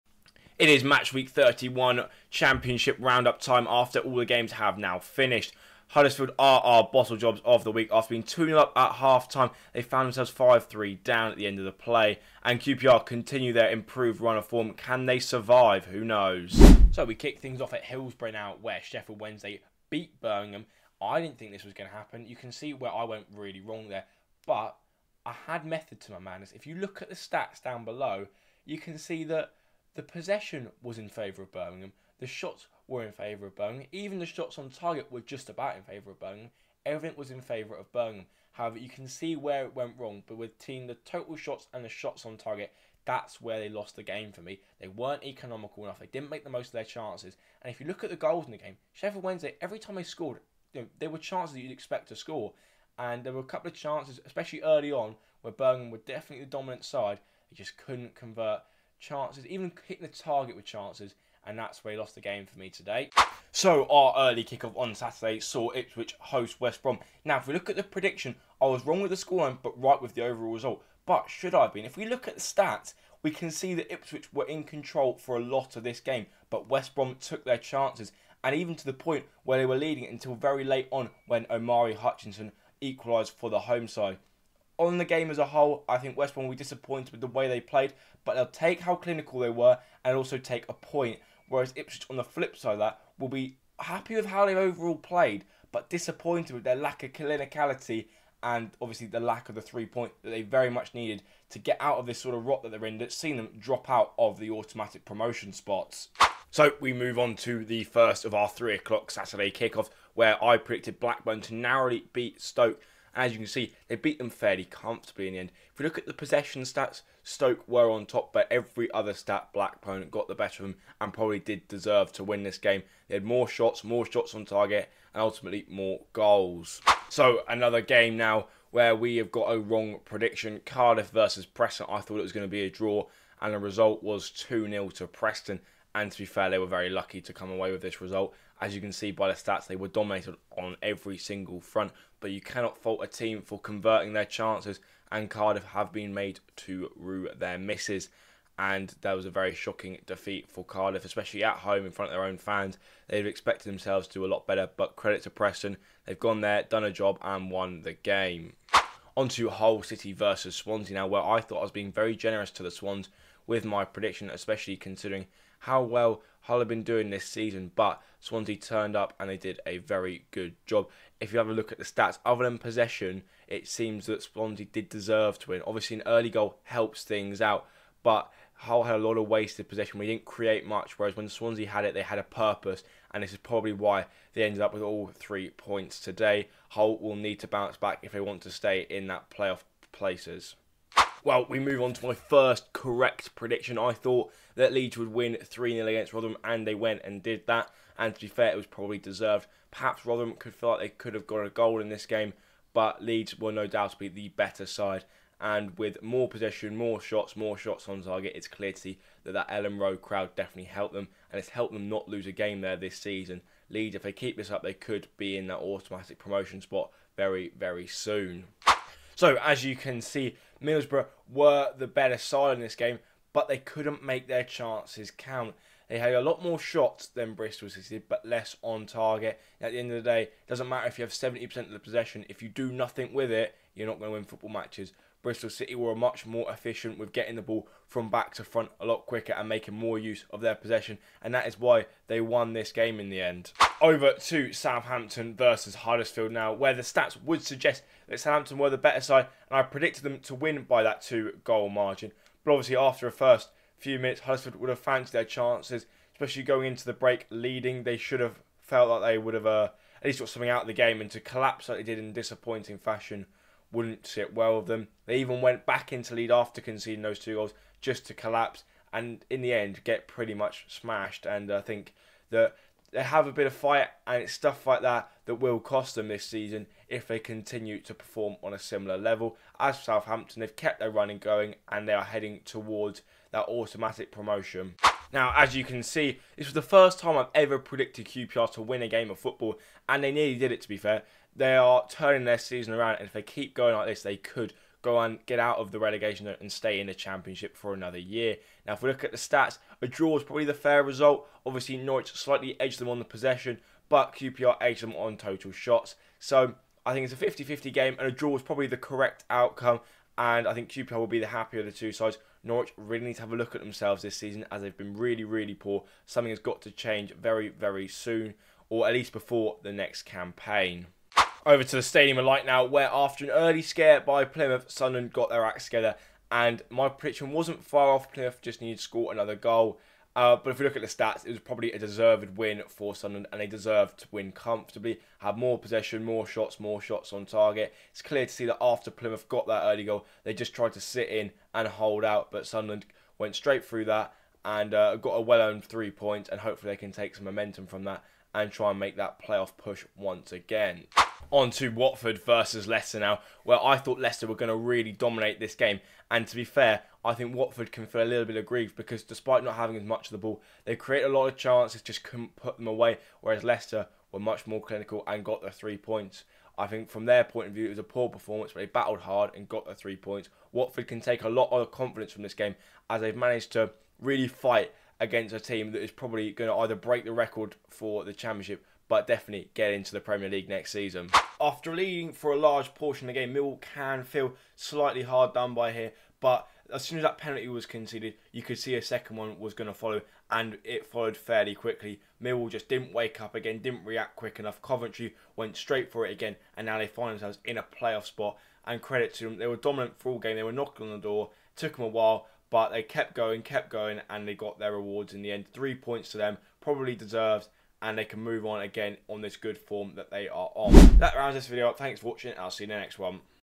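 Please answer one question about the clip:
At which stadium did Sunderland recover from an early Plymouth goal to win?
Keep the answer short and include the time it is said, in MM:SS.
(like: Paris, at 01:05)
Stadium of Light, at 05:21.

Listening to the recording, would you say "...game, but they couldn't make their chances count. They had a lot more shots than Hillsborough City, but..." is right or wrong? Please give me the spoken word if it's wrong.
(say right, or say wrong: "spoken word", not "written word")
wrong: "Bristol", not "Hillsborough".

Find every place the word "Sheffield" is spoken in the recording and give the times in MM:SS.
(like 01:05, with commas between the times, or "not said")
00:18, 00:48.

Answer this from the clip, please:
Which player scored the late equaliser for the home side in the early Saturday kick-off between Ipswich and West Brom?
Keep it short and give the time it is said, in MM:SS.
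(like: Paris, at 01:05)
Omari Hutchinson, at 01:21.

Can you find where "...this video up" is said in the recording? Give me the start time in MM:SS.
06:51.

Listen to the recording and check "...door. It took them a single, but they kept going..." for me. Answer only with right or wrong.
wrong.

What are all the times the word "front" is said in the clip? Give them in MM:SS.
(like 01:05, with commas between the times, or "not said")
02:21, 02:31, 03:58.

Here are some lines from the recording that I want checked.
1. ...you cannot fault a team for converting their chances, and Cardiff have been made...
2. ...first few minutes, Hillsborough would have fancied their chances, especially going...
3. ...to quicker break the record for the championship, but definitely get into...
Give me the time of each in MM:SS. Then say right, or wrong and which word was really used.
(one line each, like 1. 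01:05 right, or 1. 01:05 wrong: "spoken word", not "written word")
1. 02:22 right
2. 04:13 wrong: "Huddersfield", not "Hillsborough"
3. 06:16 wrong: "either", not "quicker".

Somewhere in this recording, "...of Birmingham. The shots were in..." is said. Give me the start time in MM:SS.
00:31.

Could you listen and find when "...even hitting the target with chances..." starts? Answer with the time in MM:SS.
00:59.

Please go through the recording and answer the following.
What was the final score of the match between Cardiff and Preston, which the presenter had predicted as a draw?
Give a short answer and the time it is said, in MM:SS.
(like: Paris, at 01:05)
2-0 to Preston, at 02:14.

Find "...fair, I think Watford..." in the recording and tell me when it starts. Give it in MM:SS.
05:56.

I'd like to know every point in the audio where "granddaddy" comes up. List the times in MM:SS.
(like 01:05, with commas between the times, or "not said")
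not said.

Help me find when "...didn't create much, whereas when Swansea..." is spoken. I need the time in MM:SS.
03:00.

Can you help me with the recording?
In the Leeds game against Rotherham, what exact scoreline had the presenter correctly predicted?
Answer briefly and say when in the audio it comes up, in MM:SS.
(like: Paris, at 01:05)
3-0, at 03:15.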